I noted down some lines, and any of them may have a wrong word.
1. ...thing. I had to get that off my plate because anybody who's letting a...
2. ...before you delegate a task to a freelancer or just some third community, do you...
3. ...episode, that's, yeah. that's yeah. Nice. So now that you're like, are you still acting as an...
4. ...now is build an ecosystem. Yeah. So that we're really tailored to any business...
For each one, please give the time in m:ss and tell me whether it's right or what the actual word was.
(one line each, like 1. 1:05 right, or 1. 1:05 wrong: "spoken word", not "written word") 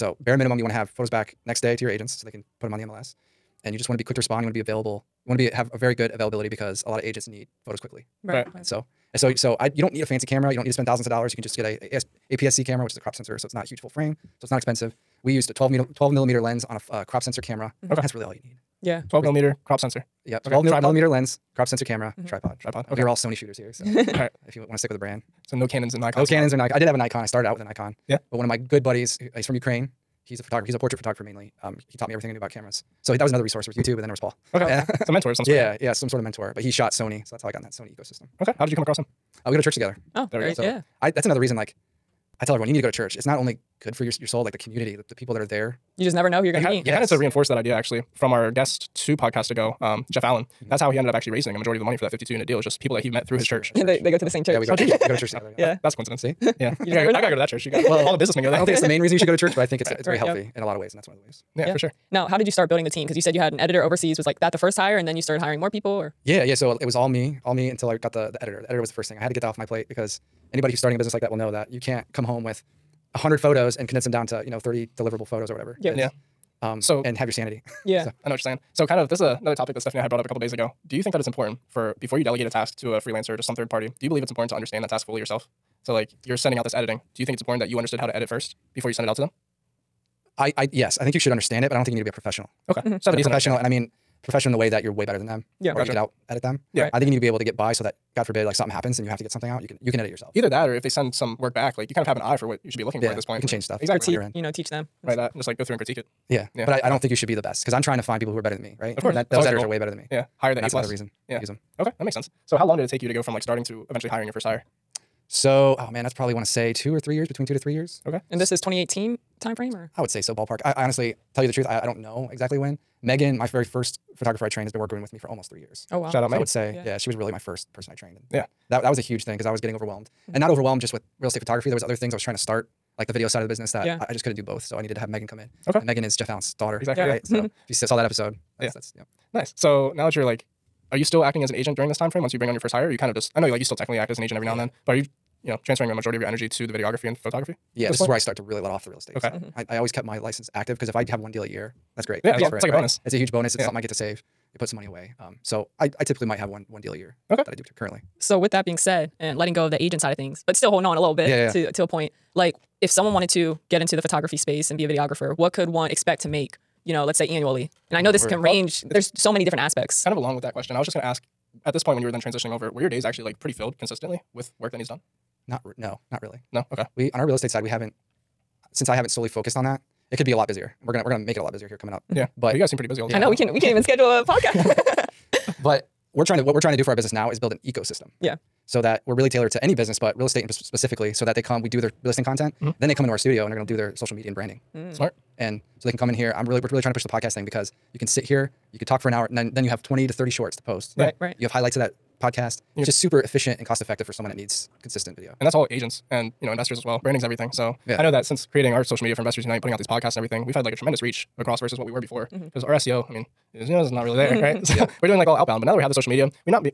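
1. 1:09 wrong: "starting", not "letting"
2. 1:22 wrong: "party", not "community"
3. 2:18 right
4. 3:07 right.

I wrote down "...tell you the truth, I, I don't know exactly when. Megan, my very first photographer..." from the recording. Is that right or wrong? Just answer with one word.
right.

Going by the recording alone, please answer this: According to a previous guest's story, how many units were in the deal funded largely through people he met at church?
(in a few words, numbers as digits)
52.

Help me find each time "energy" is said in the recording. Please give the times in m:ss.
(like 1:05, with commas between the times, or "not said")
2:26.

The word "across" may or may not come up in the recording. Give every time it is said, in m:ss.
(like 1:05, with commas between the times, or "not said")
0:38, 3:31.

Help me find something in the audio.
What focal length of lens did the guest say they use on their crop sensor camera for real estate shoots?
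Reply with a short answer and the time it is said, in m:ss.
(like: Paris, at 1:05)
12mm, at 0:15.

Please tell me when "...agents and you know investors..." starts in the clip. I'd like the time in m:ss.
3:25.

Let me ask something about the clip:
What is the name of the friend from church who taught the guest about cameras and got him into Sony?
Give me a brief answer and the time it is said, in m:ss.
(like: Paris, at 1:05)
Paul, at 0:34.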